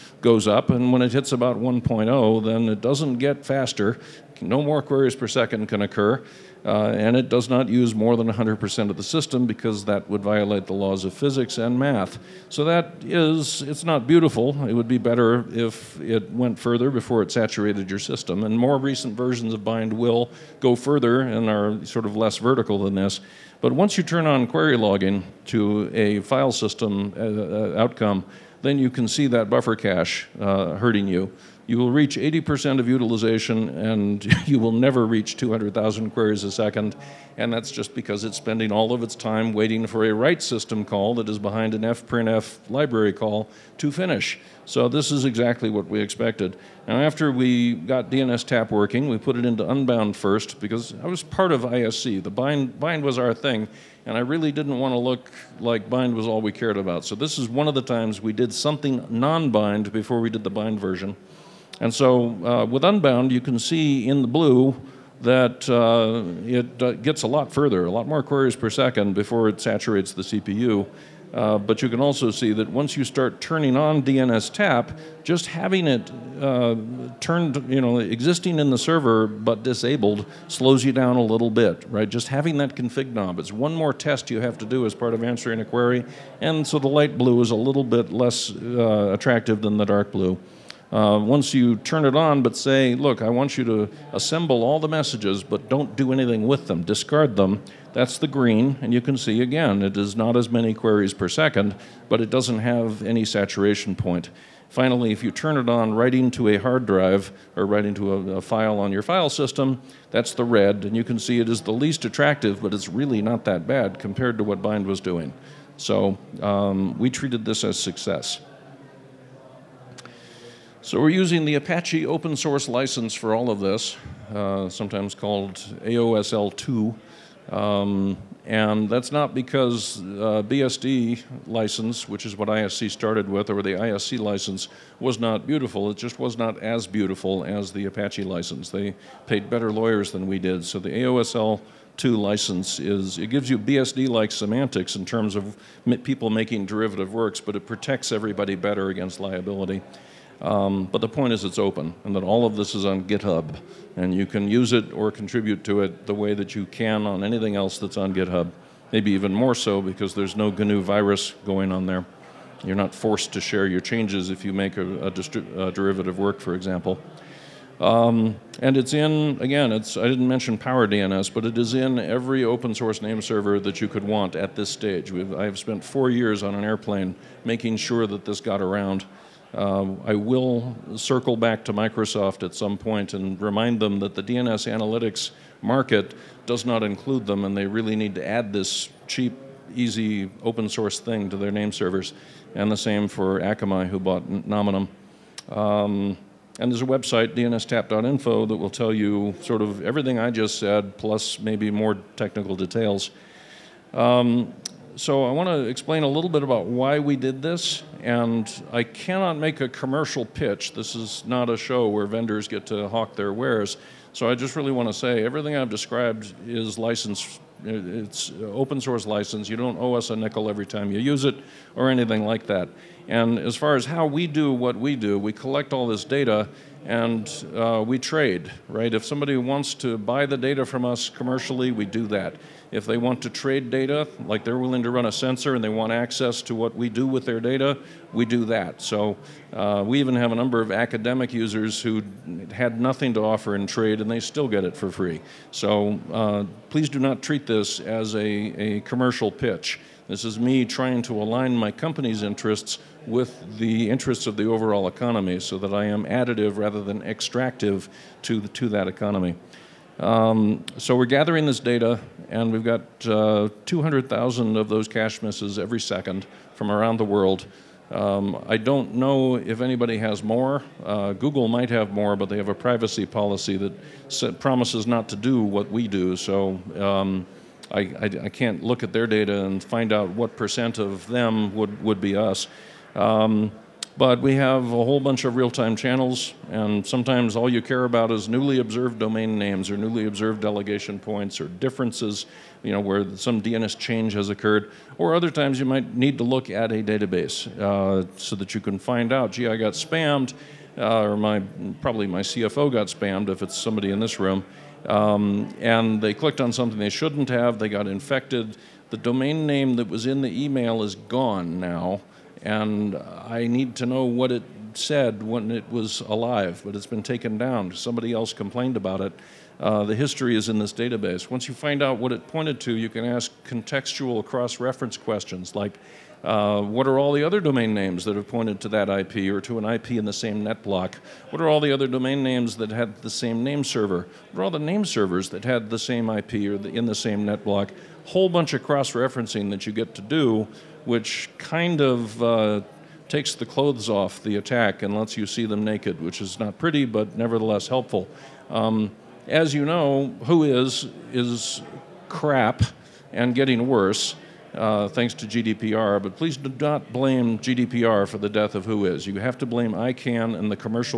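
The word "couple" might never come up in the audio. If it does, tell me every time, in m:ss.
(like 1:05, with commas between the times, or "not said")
not said.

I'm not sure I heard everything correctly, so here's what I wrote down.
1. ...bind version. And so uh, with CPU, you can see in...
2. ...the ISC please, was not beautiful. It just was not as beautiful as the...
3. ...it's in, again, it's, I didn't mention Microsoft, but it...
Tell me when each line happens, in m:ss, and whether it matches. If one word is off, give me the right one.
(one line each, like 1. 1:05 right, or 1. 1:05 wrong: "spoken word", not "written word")
1. 1:00 wrong: "Unbound", not "CPU"
2. 2:13 wrong: "license", not "please"
3. 2:48 wrong: "PowerDNS", not "Microsoft".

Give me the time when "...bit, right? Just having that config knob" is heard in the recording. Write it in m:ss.
1:21.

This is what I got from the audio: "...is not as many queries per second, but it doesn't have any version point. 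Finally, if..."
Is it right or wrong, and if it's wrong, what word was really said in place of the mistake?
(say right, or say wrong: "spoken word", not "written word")
wrong: "saturation", not "version".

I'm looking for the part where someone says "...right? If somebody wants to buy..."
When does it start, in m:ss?
3:48.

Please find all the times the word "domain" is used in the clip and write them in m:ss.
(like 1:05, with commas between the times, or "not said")
4:48, 5:08, 5:27, 5:31.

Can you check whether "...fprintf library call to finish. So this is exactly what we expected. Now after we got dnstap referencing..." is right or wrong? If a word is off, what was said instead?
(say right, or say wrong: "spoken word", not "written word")
wrong: "working", not "referencing".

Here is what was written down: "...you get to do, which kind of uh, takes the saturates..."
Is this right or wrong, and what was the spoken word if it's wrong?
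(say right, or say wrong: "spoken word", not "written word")
wrong: "clothes", not "saturates".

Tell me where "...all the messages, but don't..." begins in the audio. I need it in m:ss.
1:34.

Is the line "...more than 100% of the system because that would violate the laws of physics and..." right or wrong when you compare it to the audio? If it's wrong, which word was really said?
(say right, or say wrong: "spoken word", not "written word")
right.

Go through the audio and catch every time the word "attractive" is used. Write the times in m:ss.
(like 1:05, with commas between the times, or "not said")
1:29, 1:52.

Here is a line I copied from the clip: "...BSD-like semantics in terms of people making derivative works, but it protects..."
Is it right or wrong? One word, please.
right.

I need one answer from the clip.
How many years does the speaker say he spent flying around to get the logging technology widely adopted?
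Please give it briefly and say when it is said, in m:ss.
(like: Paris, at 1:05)
Four years, at 2:55.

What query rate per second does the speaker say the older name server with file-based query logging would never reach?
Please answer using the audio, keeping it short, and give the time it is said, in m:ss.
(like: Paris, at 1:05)
200,000, at 0:35.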